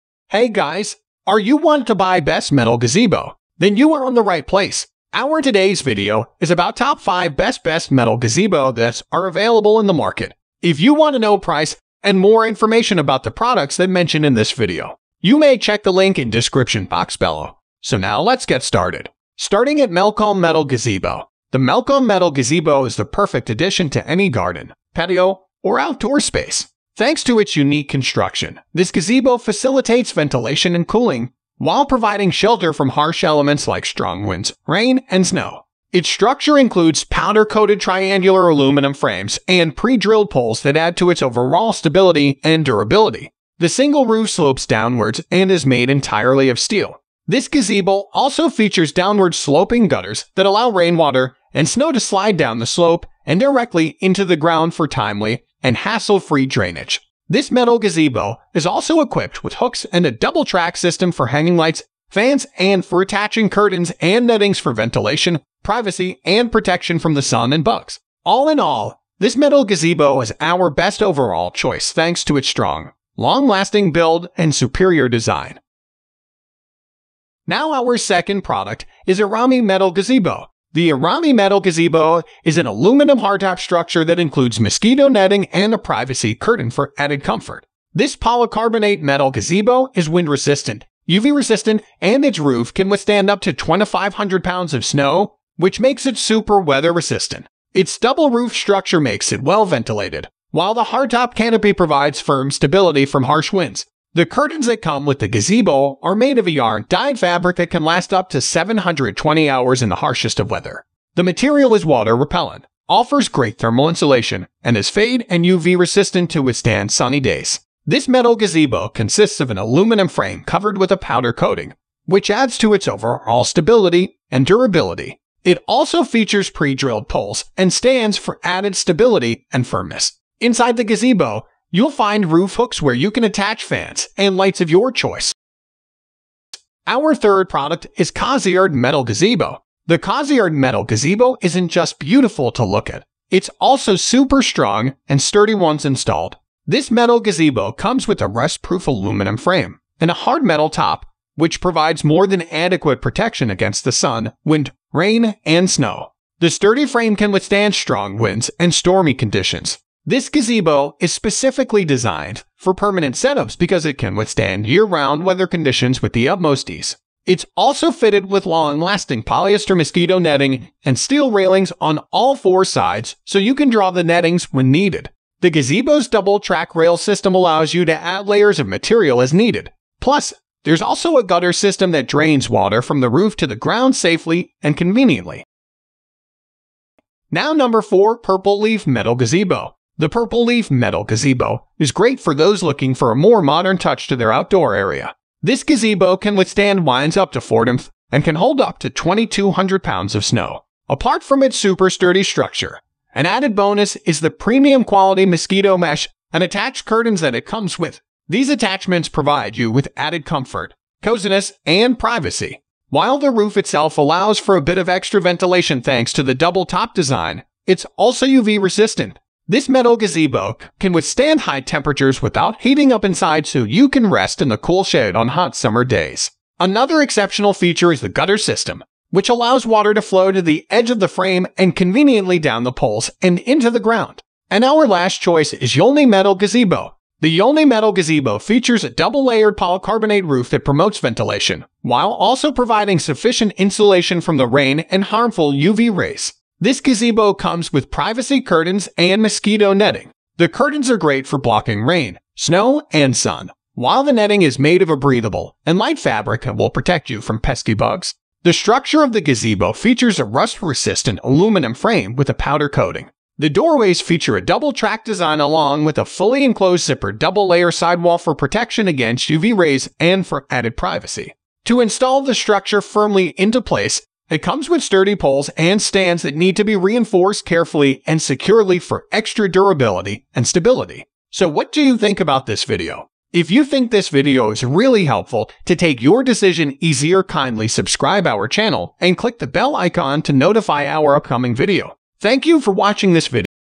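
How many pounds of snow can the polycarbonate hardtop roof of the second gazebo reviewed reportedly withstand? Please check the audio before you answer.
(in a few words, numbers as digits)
2,500 pounds.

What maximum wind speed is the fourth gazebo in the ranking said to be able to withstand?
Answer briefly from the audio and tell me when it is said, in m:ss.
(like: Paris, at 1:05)
40 mph, at 3:17.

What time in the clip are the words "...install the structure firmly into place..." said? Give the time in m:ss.
4:31.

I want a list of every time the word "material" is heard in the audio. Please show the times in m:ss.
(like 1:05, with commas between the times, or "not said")
1:51, 2:58.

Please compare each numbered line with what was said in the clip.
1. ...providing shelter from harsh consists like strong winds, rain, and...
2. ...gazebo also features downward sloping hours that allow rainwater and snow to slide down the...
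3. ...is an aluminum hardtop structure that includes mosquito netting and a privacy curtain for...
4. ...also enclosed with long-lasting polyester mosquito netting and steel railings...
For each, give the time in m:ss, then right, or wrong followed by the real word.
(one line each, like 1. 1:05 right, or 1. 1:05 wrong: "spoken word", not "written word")
1. 0:31 wrong: "elements", not "consists"
2. 0:47 wrong: "gutters", not "hours"
3. 1:22 right
4. 2:47 wrong: "fitted", not "enclosed".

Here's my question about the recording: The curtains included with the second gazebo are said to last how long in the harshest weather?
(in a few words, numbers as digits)
720 hours.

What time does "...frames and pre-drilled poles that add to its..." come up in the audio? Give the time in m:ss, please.
0:38.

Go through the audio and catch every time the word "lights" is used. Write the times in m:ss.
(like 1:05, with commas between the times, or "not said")
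1:01, 2:14, 4:15.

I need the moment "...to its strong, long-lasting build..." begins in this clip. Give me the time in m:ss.
1:12.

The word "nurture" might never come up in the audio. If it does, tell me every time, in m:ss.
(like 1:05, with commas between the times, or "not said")
not said.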